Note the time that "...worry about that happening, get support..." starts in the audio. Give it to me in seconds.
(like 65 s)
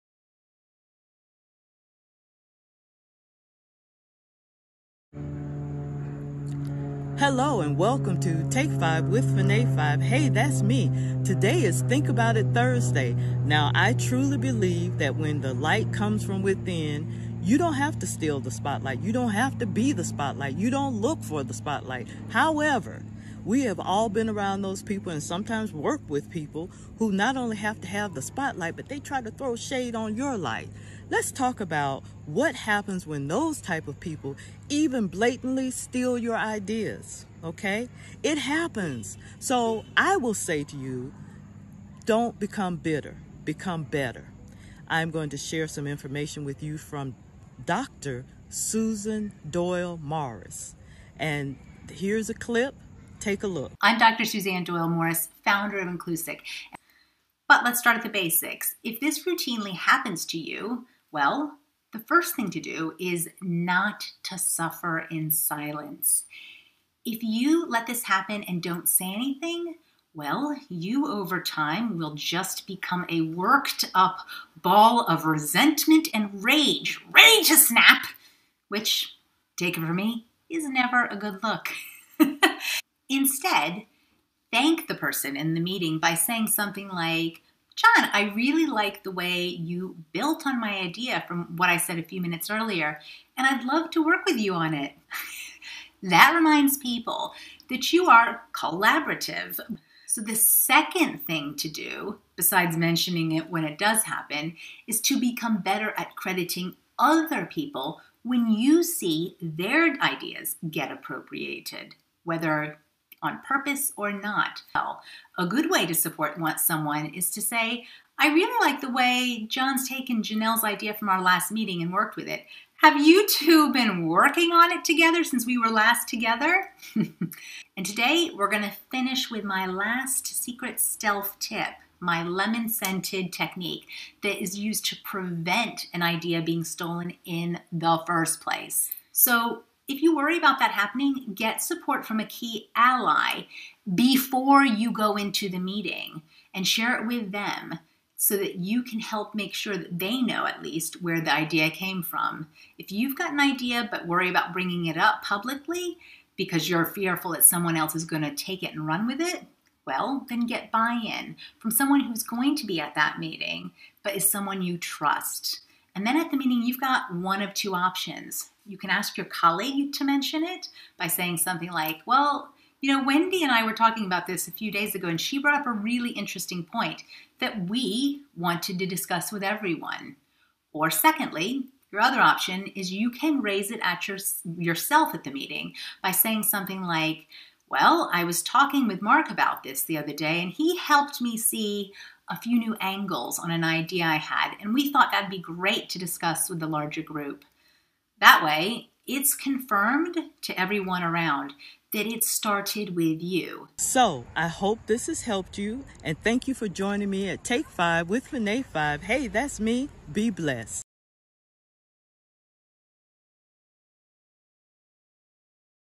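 140 s.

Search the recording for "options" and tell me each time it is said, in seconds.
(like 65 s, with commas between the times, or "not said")
167 s, 182 s.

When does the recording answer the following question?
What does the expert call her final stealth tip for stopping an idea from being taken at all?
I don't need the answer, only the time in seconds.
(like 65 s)
132 s.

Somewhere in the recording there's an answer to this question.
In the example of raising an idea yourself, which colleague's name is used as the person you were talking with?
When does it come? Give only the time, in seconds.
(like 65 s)
189 s.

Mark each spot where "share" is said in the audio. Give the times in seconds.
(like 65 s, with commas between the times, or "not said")
45 s, 146 s.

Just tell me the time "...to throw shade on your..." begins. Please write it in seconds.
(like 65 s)
29 s.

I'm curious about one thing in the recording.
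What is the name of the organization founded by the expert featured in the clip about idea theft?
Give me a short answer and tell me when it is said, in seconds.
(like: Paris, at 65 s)
InclusIQ, at 55 s.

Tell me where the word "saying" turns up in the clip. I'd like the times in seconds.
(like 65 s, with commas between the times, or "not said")
86 s, 171 s, 186 s.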